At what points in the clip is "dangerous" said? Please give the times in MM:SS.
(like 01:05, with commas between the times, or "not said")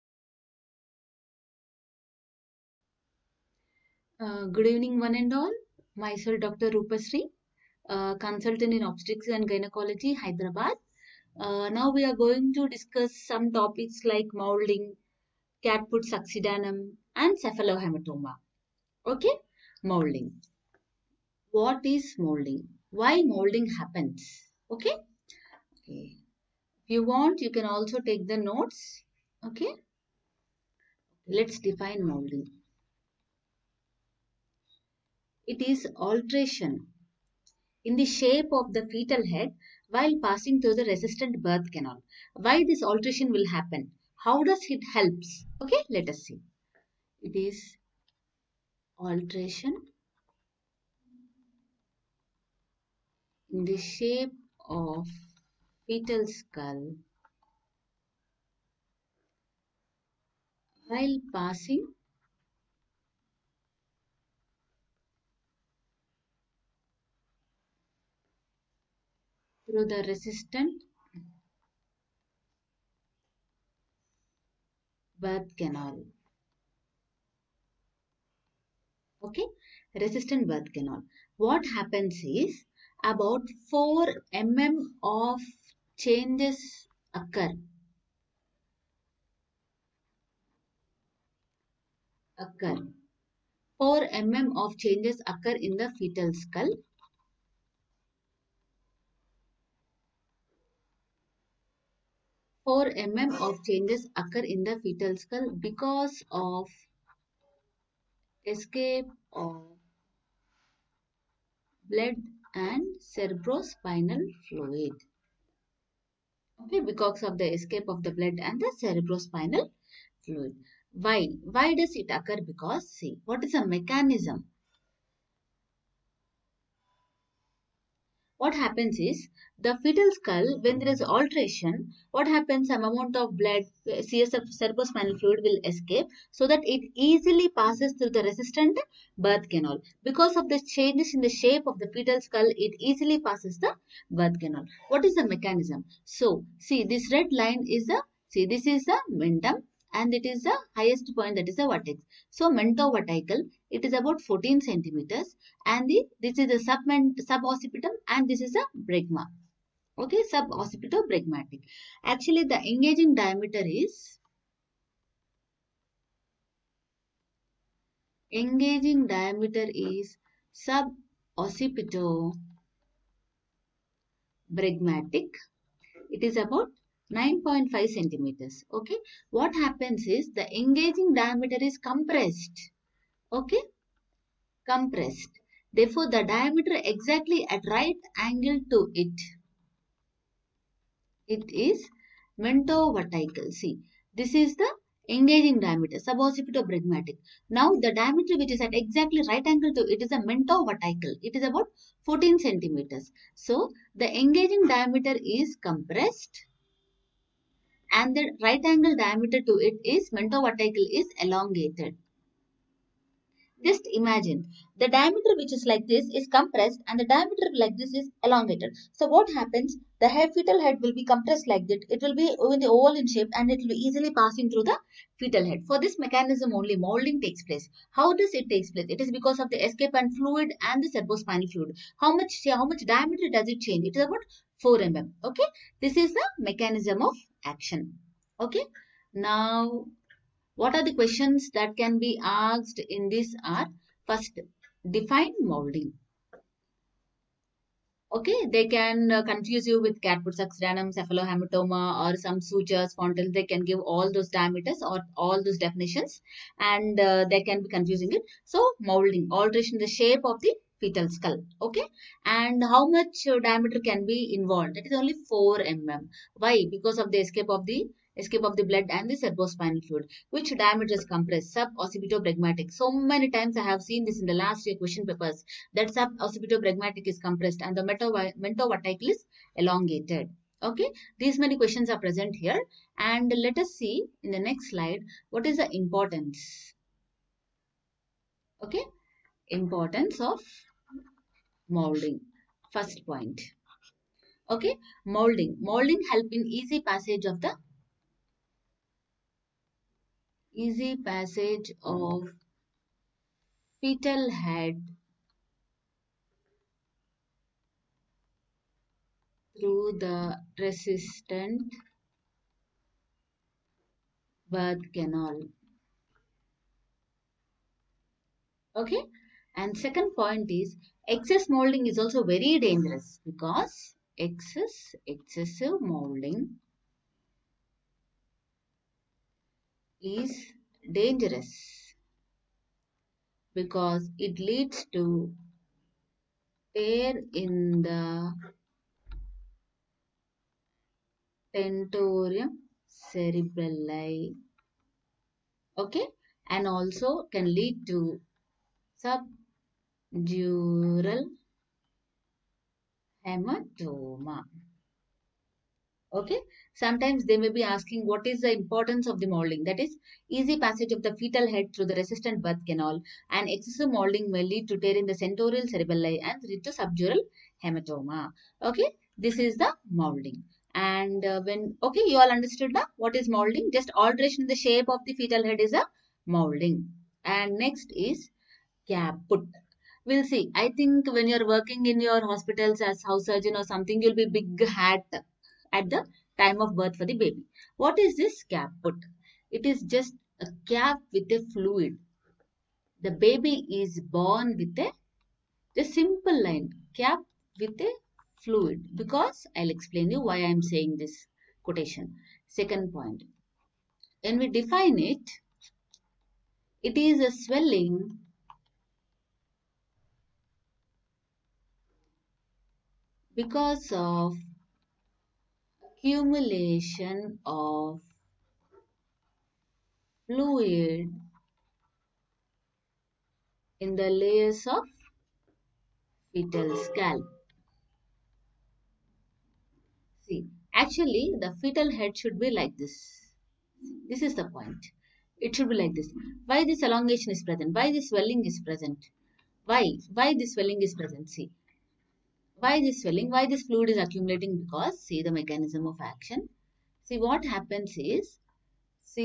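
05:22, 05:30.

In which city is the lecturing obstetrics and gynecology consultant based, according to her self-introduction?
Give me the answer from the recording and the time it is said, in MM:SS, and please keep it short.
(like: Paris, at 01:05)
Hyderabad, at 00:10.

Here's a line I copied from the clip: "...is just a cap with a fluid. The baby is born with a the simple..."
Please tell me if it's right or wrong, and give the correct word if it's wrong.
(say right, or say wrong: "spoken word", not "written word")
right.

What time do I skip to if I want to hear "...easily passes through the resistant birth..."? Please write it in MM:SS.
02:17.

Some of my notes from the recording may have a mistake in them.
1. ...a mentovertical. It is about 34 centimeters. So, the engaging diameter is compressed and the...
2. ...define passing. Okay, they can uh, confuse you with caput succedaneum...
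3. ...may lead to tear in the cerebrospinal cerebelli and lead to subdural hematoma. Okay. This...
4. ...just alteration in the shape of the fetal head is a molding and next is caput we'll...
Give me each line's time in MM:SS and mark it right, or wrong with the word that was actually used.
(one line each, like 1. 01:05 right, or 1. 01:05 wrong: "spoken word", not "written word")
1. 03:20 wrong: "14", not "34"
2. 04:04 wrong: "molding", not "passing"
3. 06:04 wrong: "tentorial", not "cerebrospinal"
4. 06:13 right.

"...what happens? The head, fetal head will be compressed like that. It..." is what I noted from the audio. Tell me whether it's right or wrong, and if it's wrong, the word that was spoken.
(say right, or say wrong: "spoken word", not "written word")
right.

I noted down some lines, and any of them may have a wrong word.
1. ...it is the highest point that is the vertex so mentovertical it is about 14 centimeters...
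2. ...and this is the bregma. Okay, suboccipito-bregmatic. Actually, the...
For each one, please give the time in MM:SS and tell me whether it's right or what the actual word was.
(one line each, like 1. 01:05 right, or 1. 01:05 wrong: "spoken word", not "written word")
1. 02:30 right
2. 02:38 right.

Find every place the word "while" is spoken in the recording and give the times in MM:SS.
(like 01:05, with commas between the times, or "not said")
00:39, 01:00.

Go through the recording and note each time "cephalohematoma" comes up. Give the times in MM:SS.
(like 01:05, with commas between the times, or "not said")
00:17, 04:10.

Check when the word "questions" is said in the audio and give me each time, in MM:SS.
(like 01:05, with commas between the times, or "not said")
04:00, 04:34, 04:41.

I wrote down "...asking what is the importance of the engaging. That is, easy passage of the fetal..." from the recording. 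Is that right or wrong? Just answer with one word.
wrong.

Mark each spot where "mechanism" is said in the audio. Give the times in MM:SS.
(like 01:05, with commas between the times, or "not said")
02:03, 02:25, 03:45, 03:56, 07:25.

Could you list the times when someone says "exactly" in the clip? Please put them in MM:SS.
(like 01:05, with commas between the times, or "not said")
03:06, 03:18.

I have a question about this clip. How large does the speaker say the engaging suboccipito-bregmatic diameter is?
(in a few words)
9.5 centimeters.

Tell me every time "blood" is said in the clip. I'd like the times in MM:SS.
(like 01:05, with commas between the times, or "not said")
01:51, 01:58, 02:13, 04:28.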